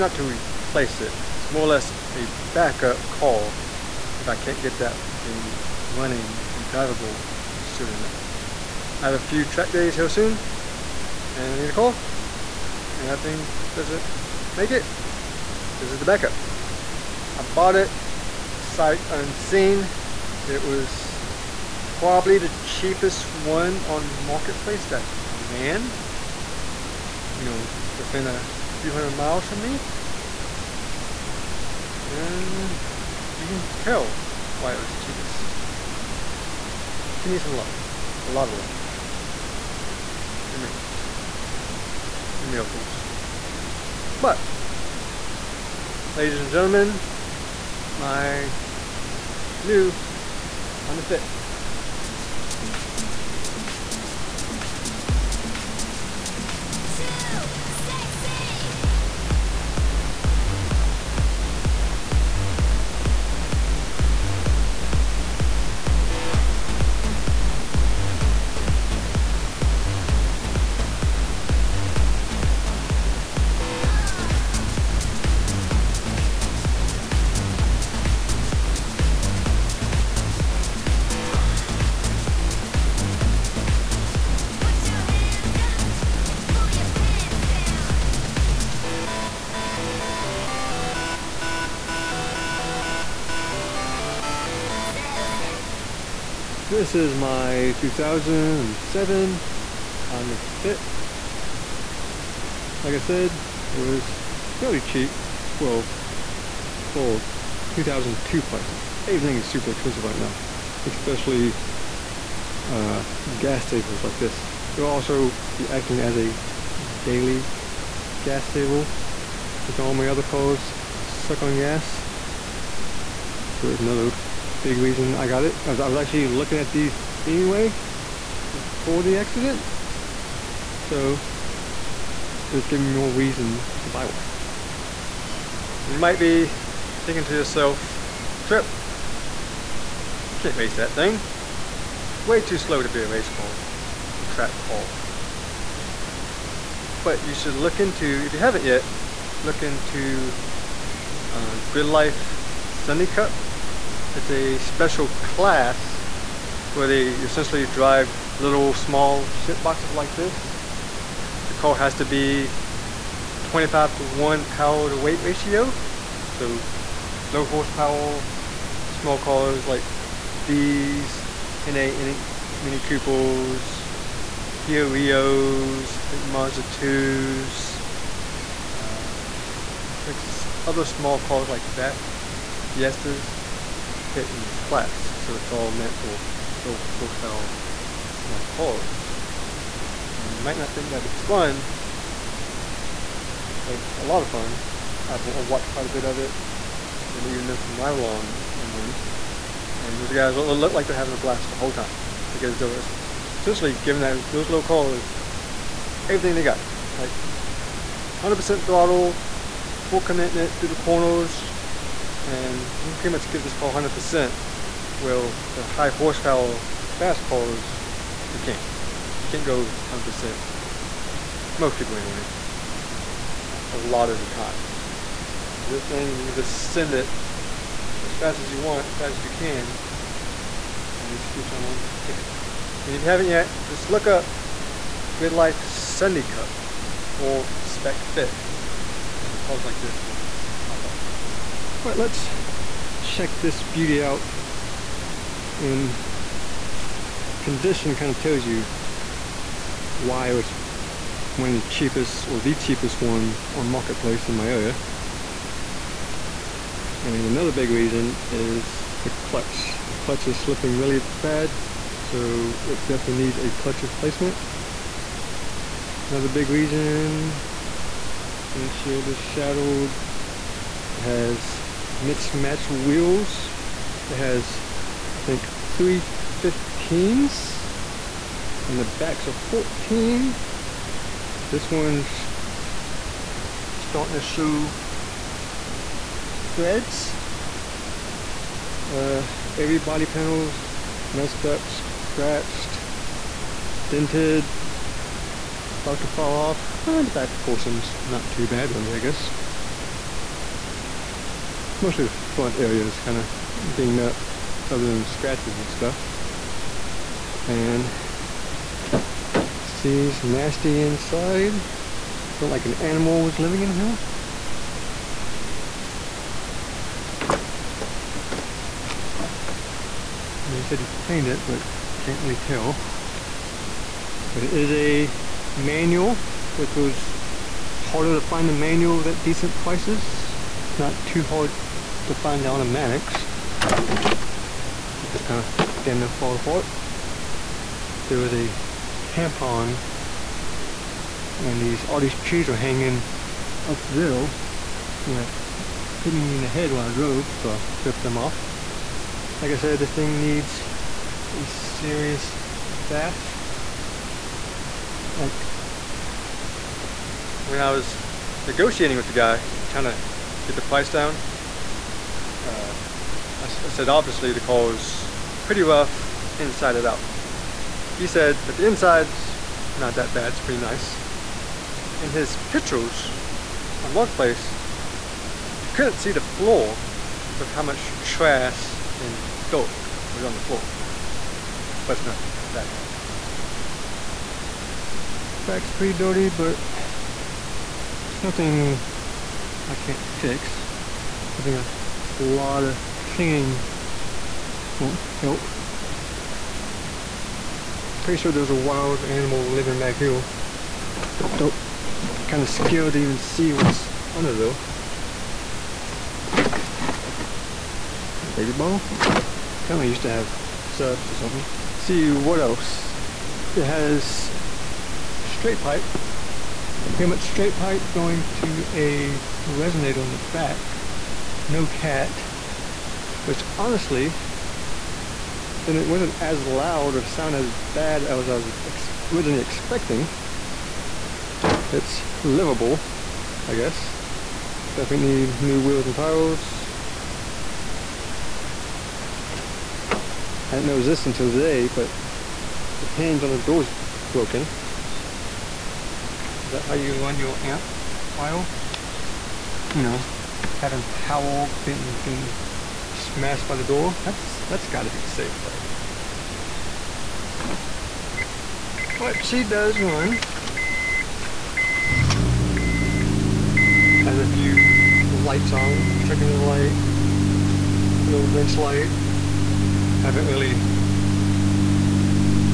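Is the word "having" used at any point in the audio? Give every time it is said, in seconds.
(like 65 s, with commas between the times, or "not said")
200 s, 450 s.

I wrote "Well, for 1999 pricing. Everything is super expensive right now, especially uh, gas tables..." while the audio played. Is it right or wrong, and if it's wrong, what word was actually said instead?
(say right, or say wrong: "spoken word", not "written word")
wrong: "2002", not "1999".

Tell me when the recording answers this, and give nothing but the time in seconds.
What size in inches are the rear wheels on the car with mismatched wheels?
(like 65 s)
279 s.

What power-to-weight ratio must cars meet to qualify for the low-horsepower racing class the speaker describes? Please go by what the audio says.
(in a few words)
25 to 1.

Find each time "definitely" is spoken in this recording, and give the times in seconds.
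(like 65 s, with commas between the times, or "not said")
262 s, 434 s.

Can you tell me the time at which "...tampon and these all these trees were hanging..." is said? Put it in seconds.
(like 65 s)
339 s.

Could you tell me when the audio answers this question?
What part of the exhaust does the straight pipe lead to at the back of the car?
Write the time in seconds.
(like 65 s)
419 s.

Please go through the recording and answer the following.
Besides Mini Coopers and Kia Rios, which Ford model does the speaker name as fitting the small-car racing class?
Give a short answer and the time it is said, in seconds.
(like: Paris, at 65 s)
Fiestas, at 182 s.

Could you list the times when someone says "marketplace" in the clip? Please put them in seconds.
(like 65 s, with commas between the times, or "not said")
24 s, 253 s, 373 s.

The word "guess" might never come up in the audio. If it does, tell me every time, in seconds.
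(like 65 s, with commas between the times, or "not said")
299 s, 433 s.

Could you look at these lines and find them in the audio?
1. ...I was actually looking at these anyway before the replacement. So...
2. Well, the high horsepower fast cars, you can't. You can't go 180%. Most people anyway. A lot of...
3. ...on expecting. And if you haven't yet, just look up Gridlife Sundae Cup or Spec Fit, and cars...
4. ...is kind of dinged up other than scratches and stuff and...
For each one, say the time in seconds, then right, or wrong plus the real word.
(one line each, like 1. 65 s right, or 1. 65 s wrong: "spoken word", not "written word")
1. 125 s wrong: "accident", not "replacement"
2. 214 s wrong: "100", not "180"
3. 231 s wrong: "ticking", not "expecting"
4. 302 s right.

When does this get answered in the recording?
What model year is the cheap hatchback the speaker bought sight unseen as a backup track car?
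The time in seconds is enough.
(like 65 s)
97 s.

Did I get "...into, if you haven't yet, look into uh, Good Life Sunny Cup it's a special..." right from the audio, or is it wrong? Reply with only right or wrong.
right.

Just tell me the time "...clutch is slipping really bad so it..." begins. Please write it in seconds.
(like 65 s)
259 s.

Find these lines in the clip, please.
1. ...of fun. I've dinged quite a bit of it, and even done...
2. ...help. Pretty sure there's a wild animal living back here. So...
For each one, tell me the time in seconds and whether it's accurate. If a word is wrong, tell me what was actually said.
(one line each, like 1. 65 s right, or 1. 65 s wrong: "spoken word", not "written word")
1. 194 s wrong: "watched", not "dinged"
2. 395 s right.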